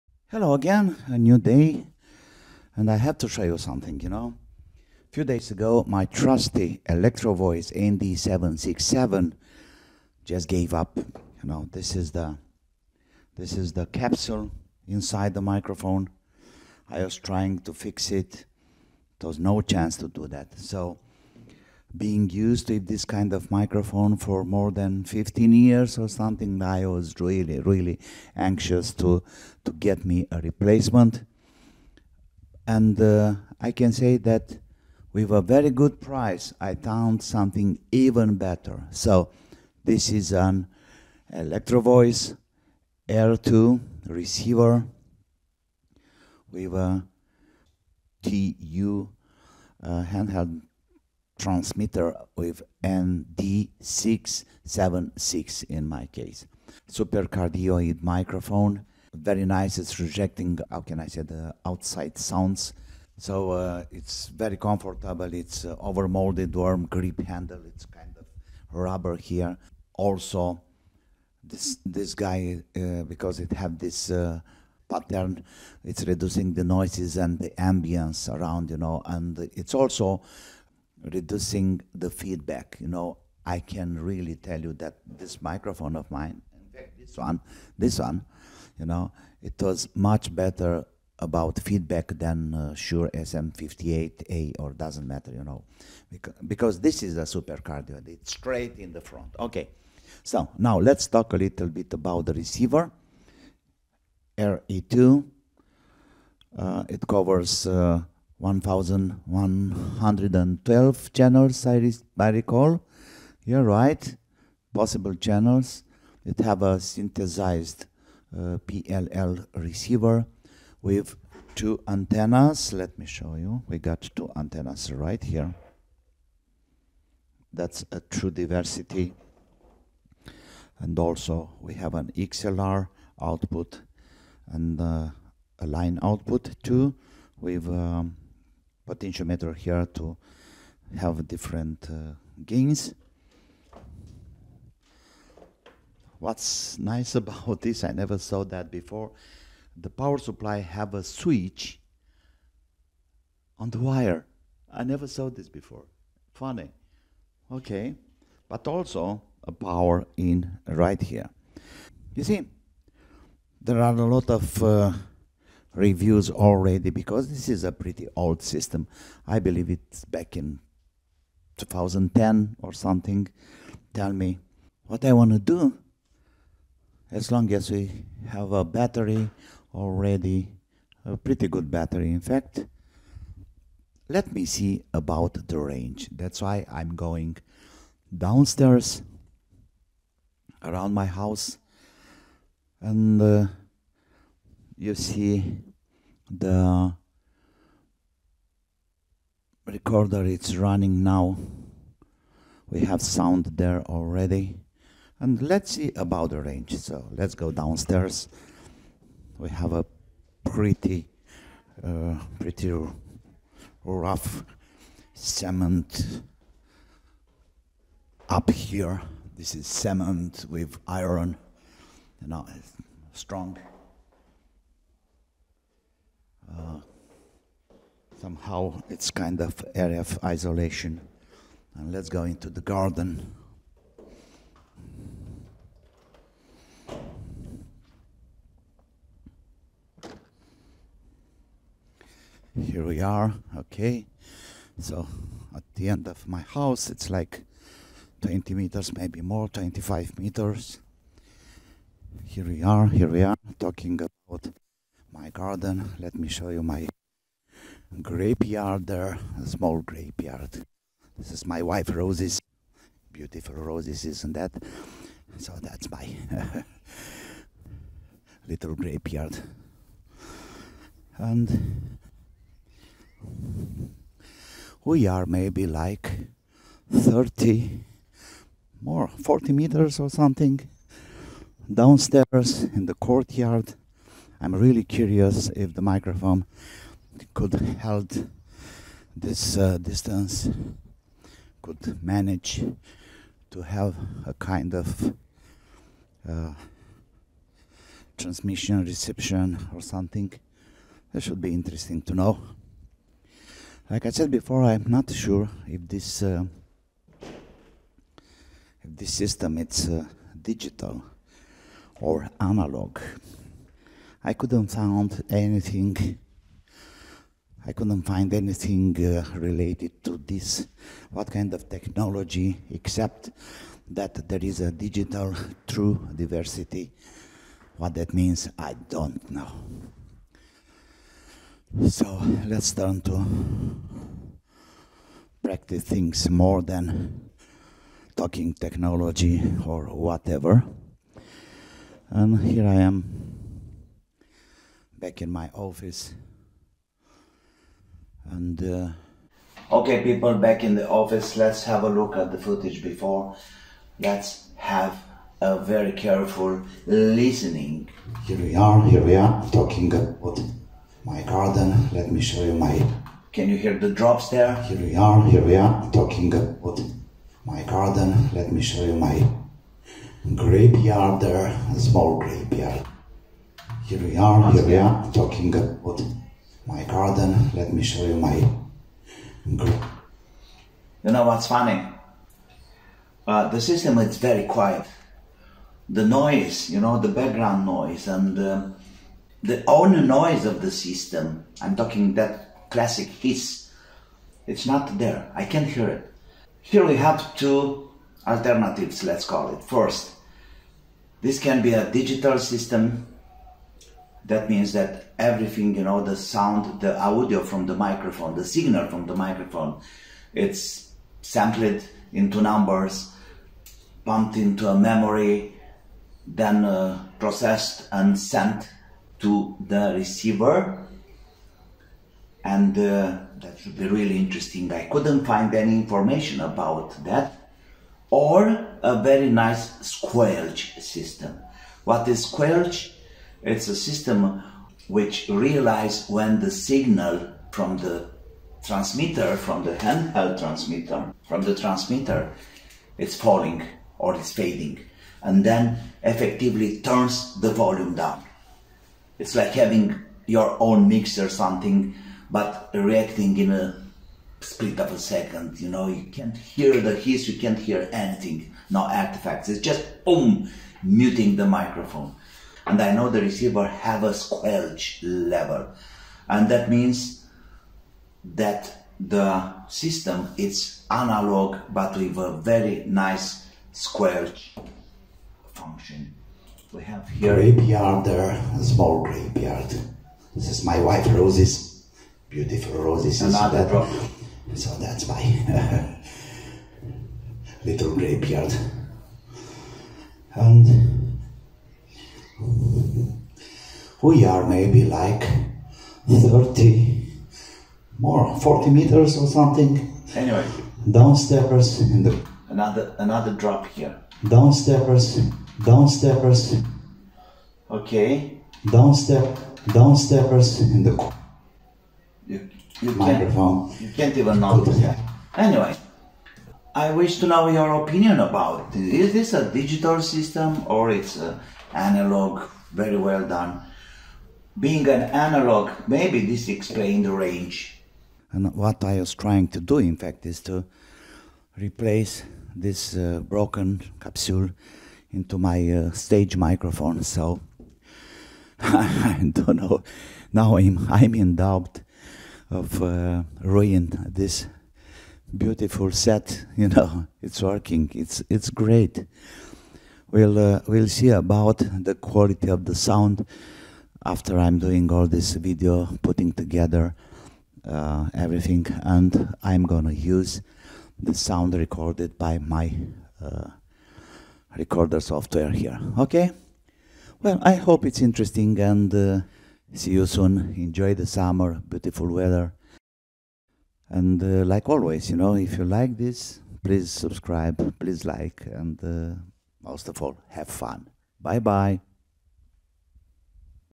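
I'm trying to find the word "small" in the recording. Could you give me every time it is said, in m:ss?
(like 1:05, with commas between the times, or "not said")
4:19, 6:11, 7:58.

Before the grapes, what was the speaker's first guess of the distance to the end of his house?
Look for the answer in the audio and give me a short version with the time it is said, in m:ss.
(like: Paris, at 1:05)
20 meters, at 4:08.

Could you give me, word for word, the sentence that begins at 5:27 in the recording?
What that means, I don't know.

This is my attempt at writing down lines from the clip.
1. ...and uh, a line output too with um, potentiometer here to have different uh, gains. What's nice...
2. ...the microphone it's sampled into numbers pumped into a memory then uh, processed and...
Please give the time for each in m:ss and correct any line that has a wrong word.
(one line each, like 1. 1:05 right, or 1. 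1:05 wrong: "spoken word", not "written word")
1. 2:14 right
2. 6:49 right.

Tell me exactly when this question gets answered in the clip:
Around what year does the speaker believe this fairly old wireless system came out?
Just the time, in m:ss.
2:51.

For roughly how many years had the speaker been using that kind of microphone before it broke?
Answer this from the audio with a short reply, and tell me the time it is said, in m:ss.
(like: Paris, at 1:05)
15, at 0:25.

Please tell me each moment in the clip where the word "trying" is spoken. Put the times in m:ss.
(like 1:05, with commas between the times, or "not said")
0:17, 8:49.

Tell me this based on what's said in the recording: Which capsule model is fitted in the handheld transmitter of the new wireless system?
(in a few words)
ND676.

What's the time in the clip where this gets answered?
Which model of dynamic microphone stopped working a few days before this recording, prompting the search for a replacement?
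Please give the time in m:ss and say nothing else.
0:06.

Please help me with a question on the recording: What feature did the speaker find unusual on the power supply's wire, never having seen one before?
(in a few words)
a switch.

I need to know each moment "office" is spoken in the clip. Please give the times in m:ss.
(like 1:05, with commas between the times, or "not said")
5:45, 5:50.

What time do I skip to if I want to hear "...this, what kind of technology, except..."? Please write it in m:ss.
5:20.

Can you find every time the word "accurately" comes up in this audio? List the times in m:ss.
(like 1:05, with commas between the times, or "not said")
not said.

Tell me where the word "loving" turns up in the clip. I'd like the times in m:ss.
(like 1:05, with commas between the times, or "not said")
not said.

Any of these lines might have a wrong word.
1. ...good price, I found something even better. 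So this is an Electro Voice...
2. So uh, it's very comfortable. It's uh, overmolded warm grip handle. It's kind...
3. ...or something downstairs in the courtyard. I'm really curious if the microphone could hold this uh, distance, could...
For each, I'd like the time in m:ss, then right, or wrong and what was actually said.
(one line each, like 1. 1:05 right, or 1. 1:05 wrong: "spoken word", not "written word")
1. 0:35 right
2. 1:03 right
3. 4:39 right.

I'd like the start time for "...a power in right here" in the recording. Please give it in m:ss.
2:39.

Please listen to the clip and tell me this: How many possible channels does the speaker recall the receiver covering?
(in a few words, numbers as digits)
1,112.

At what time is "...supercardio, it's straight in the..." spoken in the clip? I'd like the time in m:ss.
1:37.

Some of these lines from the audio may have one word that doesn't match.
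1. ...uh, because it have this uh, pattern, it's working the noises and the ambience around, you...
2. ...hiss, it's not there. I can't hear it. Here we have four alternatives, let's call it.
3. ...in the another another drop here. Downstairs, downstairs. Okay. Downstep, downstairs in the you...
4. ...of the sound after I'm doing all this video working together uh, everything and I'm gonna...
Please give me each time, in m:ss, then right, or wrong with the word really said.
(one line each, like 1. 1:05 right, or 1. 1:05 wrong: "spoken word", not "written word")
1. 1:12 wrong: "reducing", not "working"
2. 6:33 wrong: "two", not "four"
3. 8:21 right
4. 9:12 wrong: "putting", not "working".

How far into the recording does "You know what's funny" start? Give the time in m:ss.
6:21.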